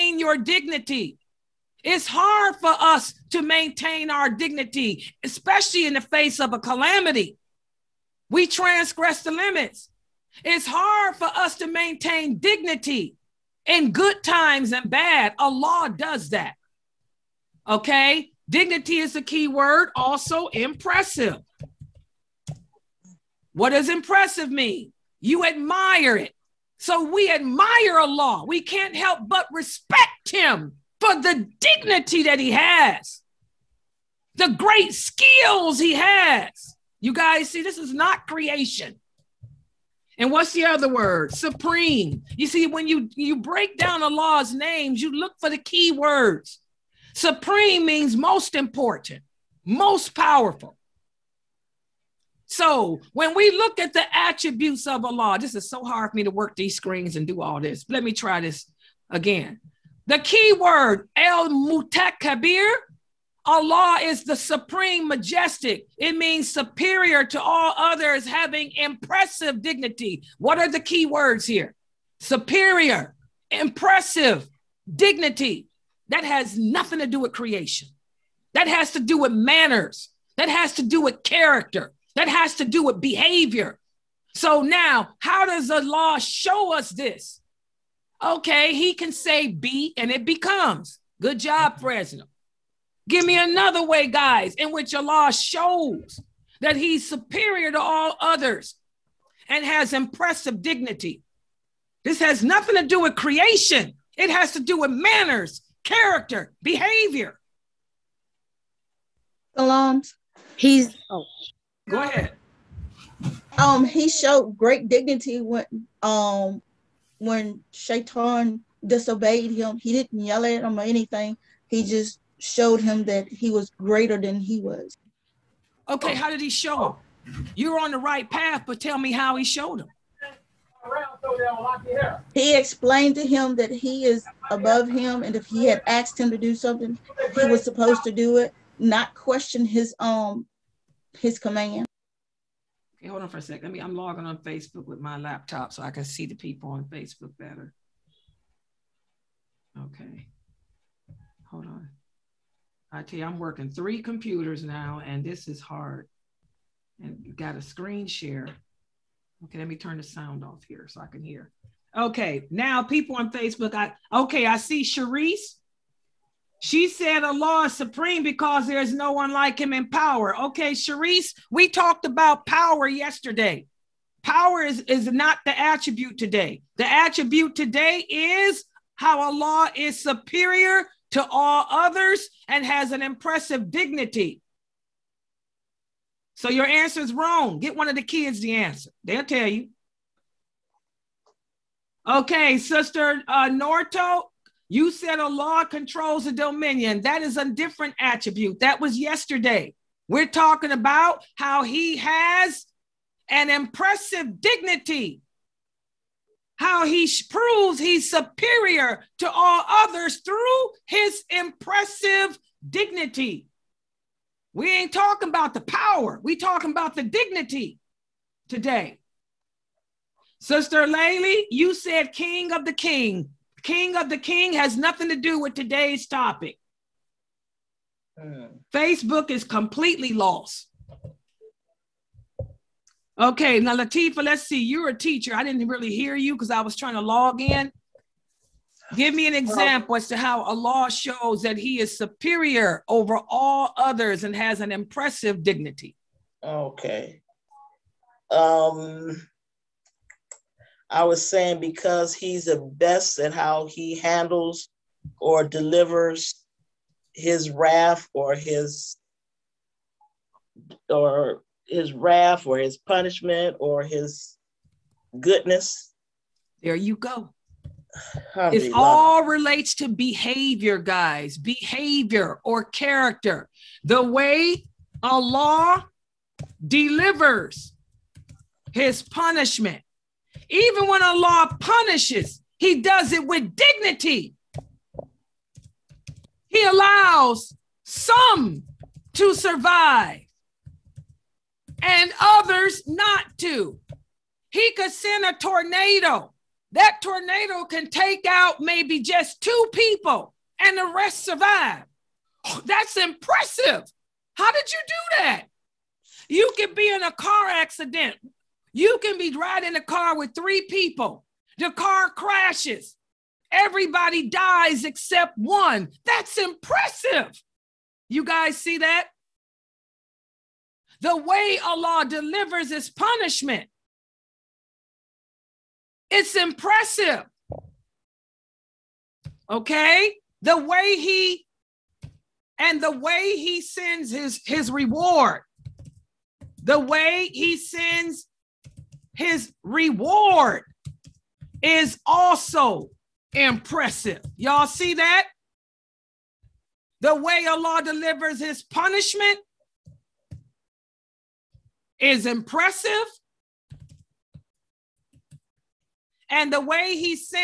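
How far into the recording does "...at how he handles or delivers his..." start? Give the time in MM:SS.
04:13.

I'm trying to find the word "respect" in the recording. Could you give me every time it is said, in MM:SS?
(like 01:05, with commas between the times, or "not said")
00:29.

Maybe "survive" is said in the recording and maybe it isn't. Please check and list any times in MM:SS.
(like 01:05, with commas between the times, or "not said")
04:49, 05:01.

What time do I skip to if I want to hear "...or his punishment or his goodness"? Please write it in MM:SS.
04:22.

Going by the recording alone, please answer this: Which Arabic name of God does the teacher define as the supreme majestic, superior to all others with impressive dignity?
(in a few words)
El Mutakabbir.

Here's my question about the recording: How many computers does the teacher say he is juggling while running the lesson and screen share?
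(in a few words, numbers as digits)
3.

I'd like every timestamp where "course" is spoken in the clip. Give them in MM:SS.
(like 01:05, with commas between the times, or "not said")
not said.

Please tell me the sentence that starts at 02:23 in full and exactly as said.
Let me, I'm logging on Facebook with my laptop so I can see the people on Facebook better.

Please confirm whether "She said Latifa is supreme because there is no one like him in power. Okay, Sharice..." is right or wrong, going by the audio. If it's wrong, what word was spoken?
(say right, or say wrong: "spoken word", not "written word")
wrong: "Allah", not "Latifa".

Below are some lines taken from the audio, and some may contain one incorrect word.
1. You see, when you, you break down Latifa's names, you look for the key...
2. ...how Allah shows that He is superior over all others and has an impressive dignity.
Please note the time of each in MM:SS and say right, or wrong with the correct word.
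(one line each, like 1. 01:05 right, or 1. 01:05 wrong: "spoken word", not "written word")
1. 00:42 wrong: "Allah", not "Latifa"
2. 04:00 right.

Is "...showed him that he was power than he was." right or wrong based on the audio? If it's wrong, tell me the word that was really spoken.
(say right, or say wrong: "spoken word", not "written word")
wrong: "greater", not "power".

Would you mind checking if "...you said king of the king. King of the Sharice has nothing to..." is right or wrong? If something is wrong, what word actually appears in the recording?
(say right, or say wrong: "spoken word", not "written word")
wrong: "King", not "Sharice".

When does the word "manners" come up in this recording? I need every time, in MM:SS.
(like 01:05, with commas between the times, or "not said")
01:19, 01:44.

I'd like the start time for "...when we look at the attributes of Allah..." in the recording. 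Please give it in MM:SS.
00:53.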